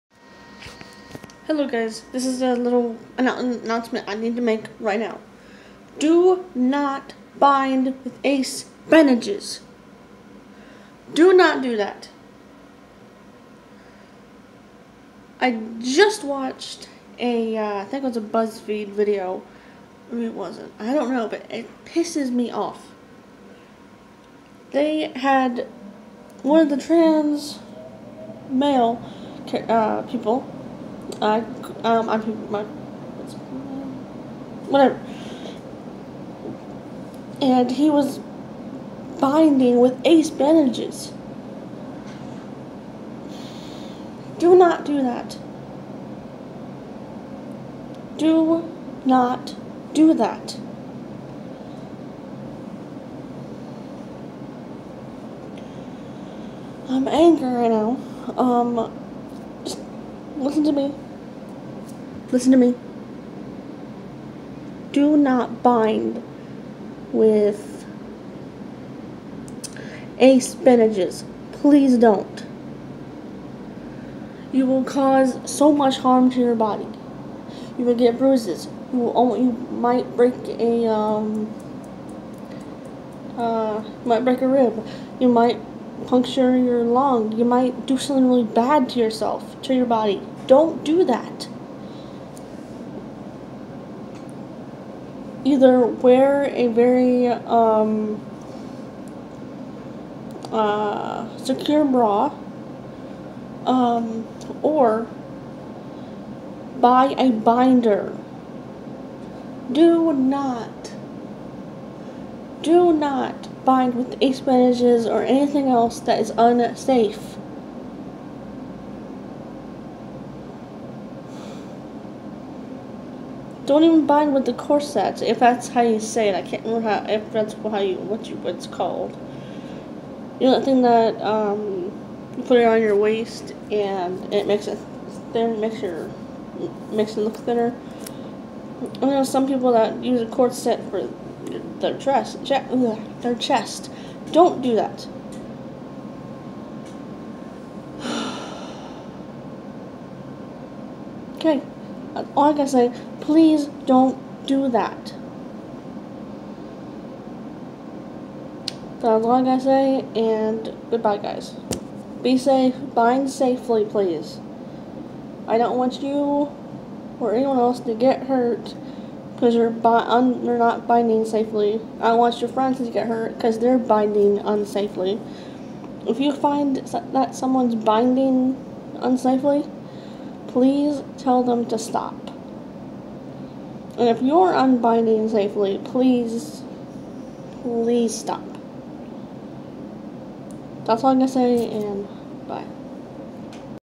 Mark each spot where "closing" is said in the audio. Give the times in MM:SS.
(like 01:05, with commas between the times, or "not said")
not said.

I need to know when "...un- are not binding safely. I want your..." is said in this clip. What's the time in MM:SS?
02:50.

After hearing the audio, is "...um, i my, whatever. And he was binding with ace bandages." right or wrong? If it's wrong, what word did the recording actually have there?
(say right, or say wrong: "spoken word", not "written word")
right.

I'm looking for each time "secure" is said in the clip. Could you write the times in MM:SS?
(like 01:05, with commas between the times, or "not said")
01:41.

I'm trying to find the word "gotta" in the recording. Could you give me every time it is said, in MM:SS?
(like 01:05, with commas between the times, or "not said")
02:39.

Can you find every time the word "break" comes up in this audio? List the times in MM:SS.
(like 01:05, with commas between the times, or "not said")
01:20, 01:24.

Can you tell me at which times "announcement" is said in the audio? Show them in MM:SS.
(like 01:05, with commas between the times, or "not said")
00:03.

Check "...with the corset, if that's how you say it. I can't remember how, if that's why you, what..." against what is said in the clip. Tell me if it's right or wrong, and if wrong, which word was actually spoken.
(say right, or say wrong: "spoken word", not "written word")
right.